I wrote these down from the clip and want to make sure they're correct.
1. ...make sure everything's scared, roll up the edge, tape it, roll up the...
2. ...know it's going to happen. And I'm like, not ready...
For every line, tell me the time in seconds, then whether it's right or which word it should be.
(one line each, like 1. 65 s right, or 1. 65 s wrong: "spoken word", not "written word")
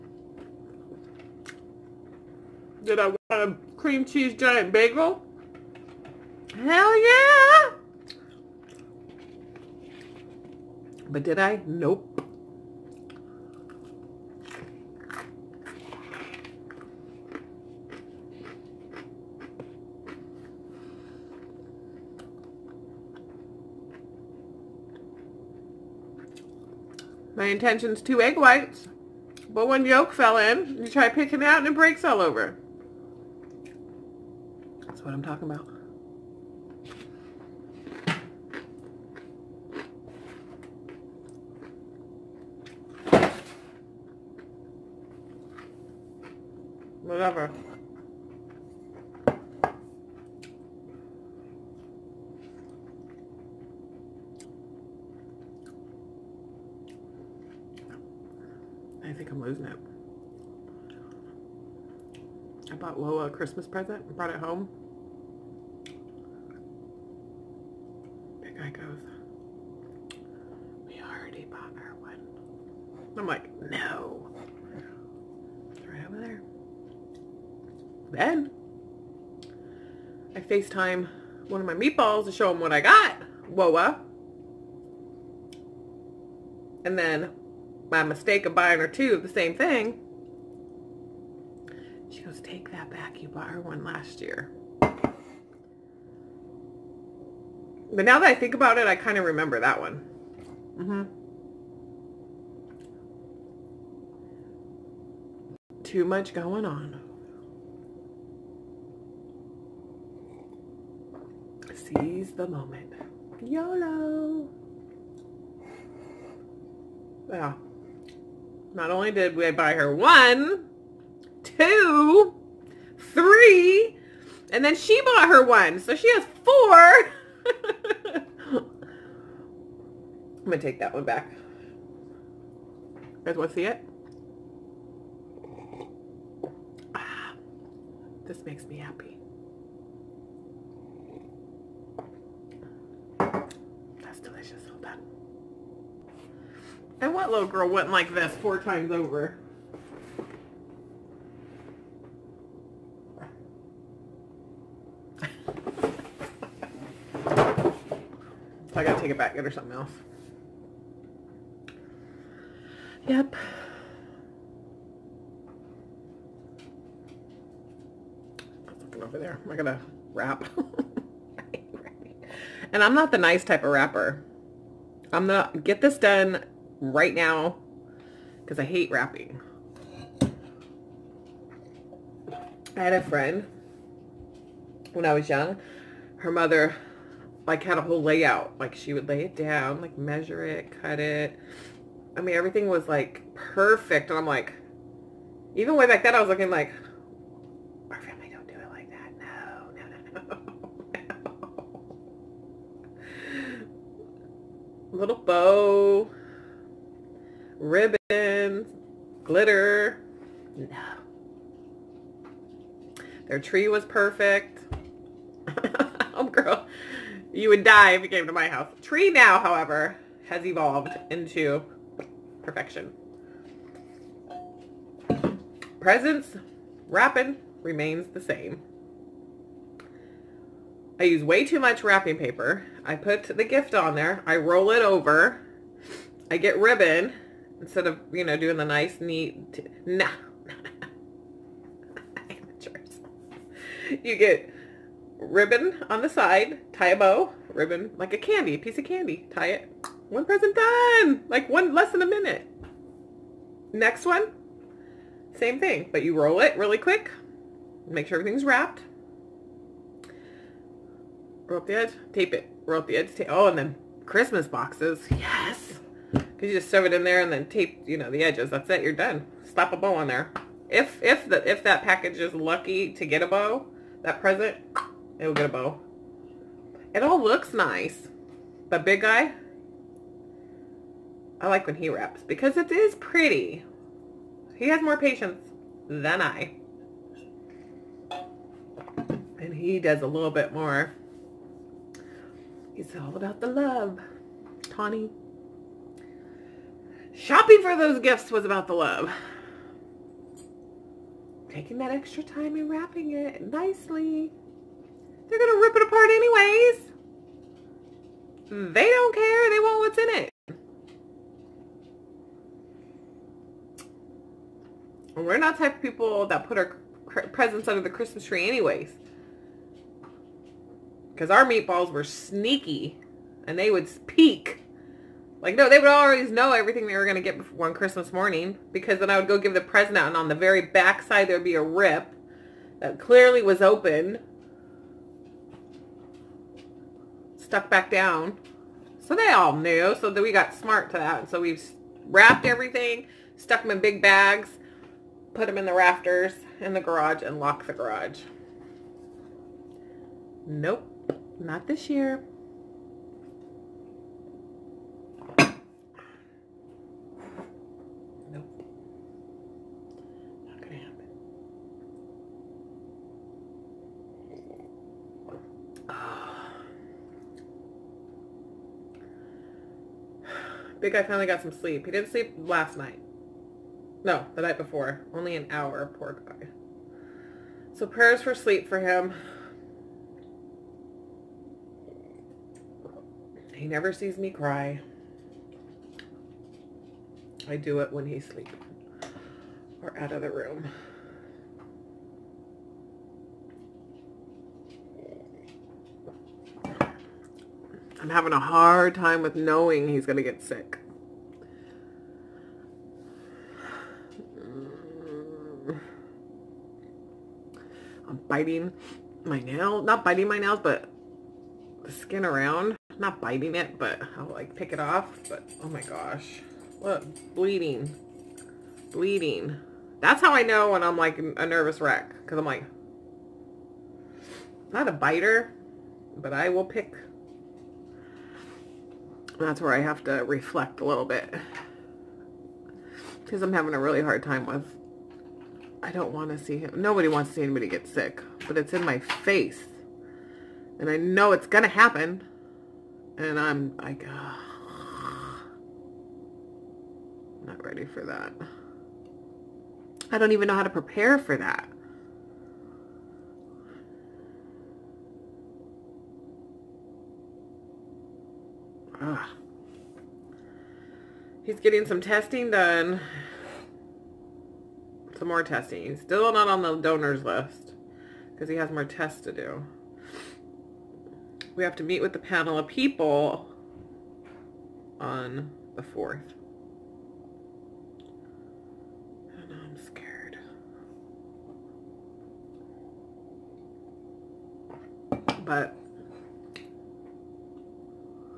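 1. 257 s wrong: "wrapped", not "scared"
2. 440 s right.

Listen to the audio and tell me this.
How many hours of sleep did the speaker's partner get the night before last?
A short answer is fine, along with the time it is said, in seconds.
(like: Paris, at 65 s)
1, at 375 s.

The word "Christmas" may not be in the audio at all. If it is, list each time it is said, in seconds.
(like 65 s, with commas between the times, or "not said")
63 s, 264 s, 317 s, 327 s.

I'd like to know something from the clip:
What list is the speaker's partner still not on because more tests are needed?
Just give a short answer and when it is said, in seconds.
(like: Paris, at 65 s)
Donors list, at 466 s.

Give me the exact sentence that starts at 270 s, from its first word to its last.
If if the if that package is lucky to get a bow, that present, it will get a bow.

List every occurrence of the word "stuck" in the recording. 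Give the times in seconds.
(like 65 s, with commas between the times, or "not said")
337 s, 343 s.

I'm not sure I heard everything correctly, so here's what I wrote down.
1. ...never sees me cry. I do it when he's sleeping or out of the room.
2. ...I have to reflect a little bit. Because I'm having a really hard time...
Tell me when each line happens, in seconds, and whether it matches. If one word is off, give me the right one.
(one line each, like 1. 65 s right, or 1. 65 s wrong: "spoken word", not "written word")
1. 383 s right
2. 429 s right.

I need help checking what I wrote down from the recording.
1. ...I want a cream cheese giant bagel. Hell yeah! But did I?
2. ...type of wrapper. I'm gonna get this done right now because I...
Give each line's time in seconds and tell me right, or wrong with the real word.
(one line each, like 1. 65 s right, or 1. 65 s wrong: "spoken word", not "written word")
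1. 3 s right
2. 173 s right.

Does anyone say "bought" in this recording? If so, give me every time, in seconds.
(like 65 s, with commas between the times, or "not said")
62 s, 93 s, 125 s.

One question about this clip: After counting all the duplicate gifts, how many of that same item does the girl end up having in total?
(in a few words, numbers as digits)
4.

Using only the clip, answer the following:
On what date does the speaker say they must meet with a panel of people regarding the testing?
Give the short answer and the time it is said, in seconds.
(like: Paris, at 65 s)
The 4th, at 475 s.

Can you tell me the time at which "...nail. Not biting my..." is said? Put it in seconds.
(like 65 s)
409 s.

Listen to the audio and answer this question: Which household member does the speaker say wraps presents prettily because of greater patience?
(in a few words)
The big guy.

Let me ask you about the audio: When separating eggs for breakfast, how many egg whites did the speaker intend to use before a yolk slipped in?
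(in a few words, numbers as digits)
2.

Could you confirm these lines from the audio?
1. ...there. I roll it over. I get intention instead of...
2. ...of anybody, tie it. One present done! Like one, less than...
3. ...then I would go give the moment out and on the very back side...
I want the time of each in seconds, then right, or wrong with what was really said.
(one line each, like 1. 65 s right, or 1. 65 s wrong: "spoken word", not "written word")
1. 233 s wrong: "ribbon", not "intention"
2. 248 s wrong: "candy", not "anybody"
3. 328 s wrong: "present", not "moment".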